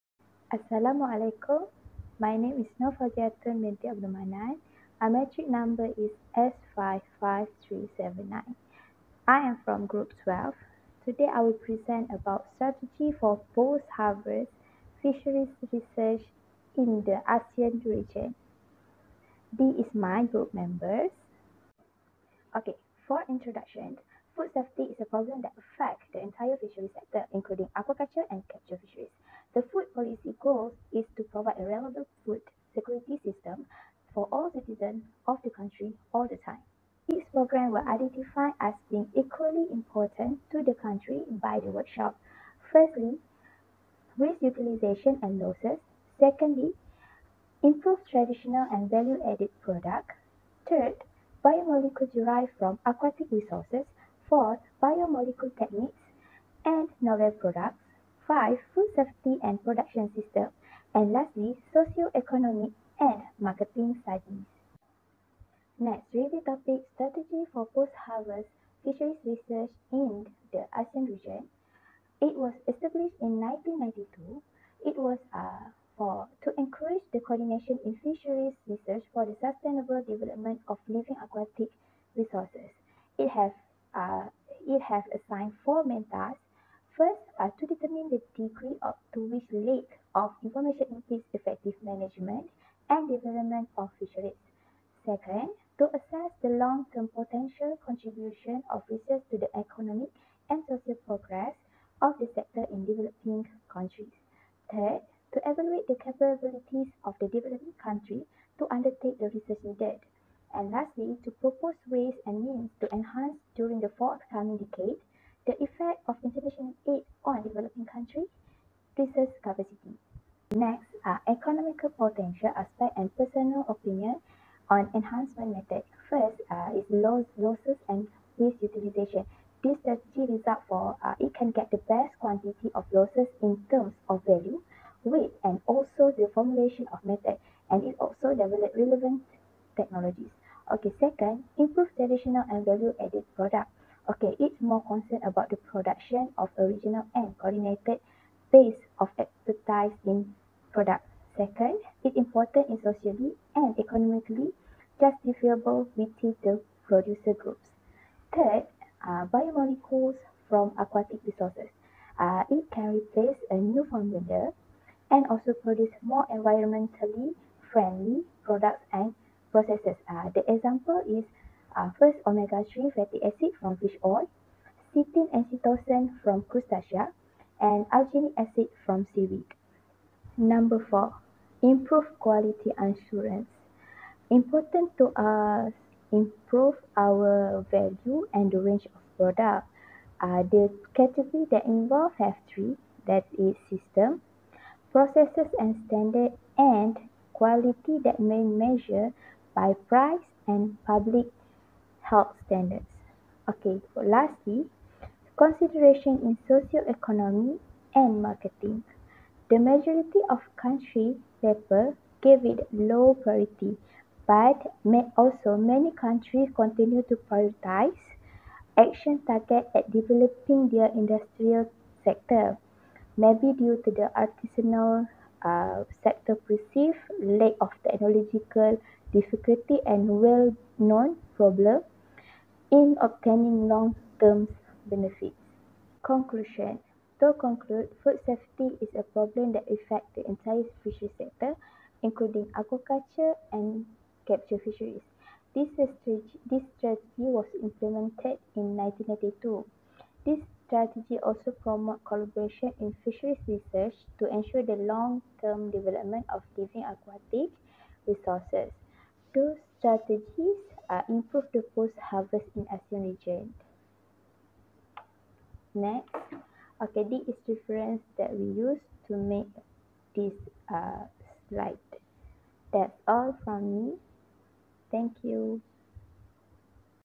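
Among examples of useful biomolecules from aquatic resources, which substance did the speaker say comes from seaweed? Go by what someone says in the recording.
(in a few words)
alginic acid.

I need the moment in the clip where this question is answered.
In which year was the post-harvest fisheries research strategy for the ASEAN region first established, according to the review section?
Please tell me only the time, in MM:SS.
01:12.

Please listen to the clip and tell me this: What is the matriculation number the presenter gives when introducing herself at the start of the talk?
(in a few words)
S55379.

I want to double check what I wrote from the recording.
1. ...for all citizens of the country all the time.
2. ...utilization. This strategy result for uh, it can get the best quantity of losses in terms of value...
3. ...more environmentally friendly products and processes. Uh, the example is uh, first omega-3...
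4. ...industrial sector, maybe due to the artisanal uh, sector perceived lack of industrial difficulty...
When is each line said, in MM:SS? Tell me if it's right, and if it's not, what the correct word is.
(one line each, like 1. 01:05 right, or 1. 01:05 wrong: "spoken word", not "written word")
1. 00:34 right
2. 02:08 right
3. 02:46 right
4. 03:40 wrong: "technological", not "industrial".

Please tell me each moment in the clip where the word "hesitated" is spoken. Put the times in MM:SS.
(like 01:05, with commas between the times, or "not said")
not said.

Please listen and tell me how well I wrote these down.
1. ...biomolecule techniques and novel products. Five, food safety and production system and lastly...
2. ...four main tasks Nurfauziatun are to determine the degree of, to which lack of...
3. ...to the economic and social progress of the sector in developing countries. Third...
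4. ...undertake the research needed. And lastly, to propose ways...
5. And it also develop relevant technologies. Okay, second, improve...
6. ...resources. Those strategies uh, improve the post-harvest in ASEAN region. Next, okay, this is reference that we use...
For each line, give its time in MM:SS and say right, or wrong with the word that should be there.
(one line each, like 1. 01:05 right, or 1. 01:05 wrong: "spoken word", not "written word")
1. 00:54 right
2. 01:25 wrong: "First", not "Nurfauziatun"
3. 01:39 right
4. 01:48 right
5. 02:17 right
6. 04:18 right.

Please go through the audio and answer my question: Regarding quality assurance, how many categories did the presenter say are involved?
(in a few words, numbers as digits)
3.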